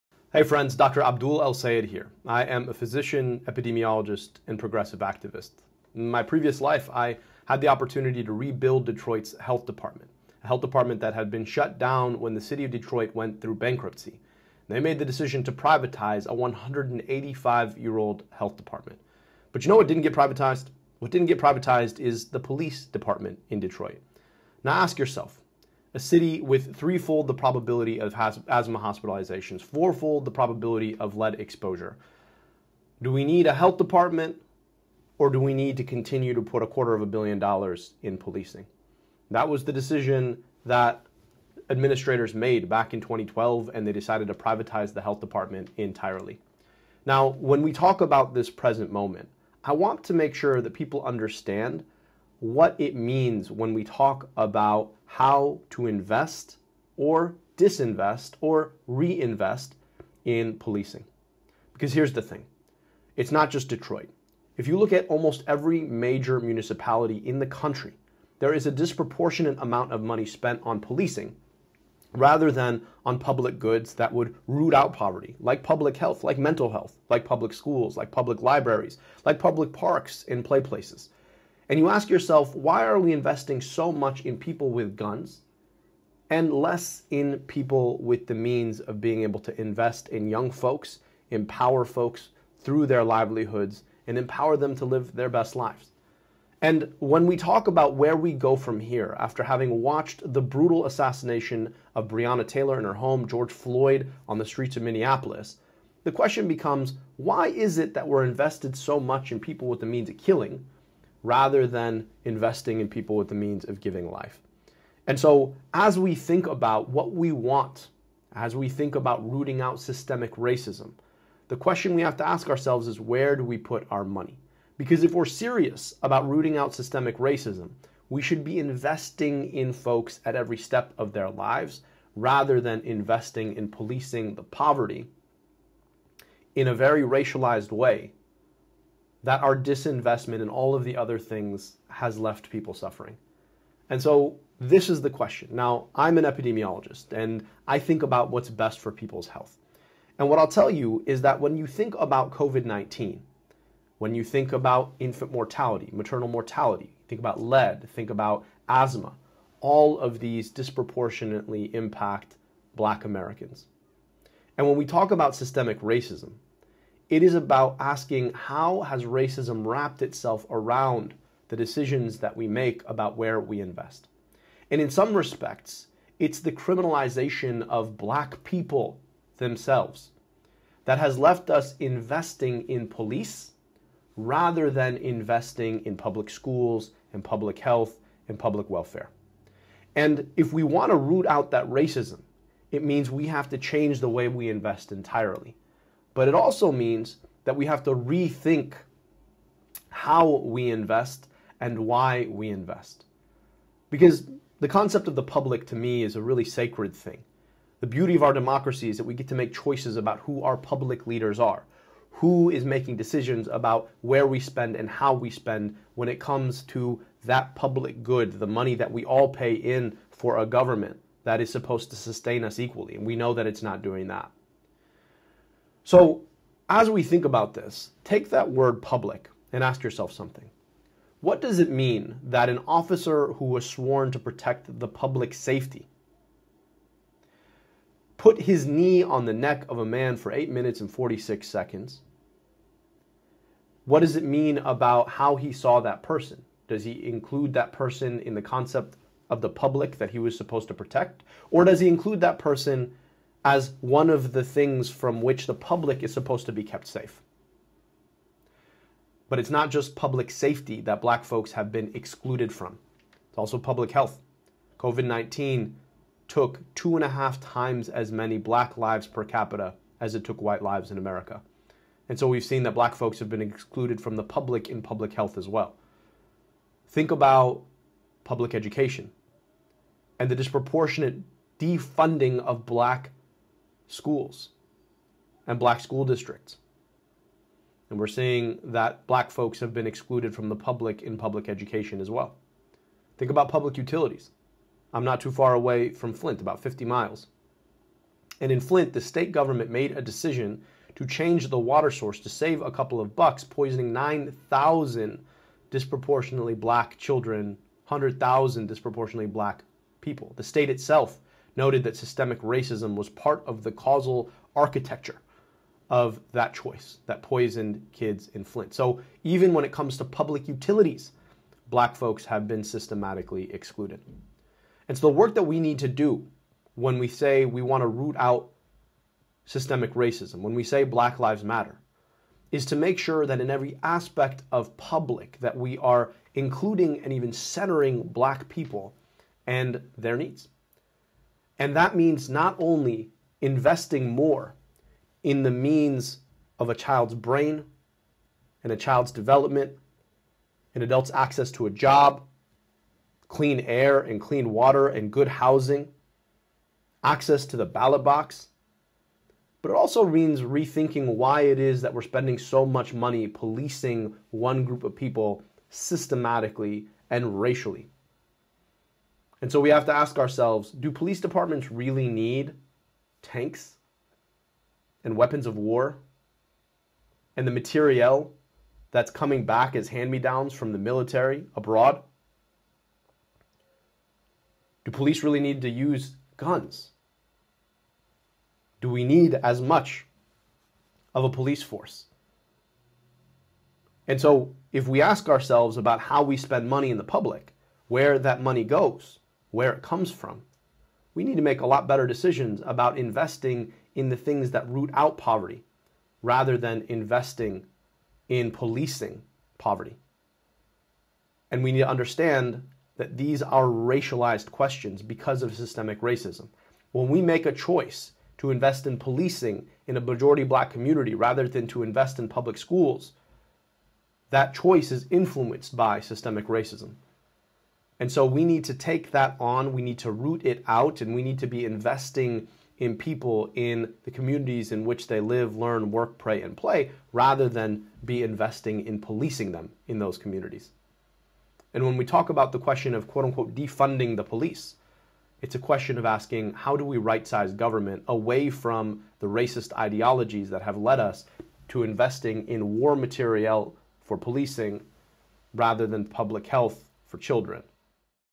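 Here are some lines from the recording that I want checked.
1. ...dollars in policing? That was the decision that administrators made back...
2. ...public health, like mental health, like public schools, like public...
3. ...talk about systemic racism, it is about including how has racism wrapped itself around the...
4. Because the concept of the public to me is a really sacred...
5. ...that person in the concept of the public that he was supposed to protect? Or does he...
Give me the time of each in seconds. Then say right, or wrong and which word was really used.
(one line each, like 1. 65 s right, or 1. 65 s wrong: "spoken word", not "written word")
1. 37 s right
2. 75 s right
3. 164 s wrong: "asking", not "including"
4. 203 s right
5. 247 s right.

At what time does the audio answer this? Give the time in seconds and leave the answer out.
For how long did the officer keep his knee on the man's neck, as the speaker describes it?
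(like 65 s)
240 s.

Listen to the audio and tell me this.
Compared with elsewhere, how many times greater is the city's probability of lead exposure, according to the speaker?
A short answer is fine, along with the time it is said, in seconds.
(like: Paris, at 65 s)
fourfold, at 29 s.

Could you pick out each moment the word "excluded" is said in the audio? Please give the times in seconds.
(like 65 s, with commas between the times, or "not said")
261 s, 273 s, 289 s, 323 s.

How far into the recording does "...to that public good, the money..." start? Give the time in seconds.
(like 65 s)
216 s.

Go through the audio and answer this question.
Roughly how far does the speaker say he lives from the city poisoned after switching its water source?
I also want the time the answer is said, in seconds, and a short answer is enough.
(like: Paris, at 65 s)
50 miles, at 296 s.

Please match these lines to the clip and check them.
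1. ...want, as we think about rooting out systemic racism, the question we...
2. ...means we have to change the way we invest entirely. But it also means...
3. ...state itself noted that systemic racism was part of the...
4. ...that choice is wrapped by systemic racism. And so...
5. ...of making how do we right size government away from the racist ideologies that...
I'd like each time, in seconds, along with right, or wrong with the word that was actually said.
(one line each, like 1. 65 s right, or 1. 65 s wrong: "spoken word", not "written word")
1. 117 s right
2. 192 s right
3. 310 s right
4. 424 s wrong: "influenced", not "wrapped"
5. 445 s wrong: "asking", not "making".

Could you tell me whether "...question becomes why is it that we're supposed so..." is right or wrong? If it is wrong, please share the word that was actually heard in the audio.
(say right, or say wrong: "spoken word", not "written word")
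wrong: "invested", not "supposed".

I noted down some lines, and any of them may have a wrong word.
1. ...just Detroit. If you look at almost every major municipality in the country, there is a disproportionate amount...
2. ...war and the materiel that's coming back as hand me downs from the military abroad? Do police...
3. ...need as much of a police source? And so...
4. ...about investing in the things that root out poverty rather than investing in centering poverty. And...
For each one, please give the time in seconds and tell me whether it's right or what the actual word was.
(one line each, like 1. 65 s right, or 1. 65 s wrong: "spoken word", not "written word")
1. 63 s right
2. 375 s right
3. 389 s wrong: "force", not "source"
4. 402 s wrong: "policing", not "centering".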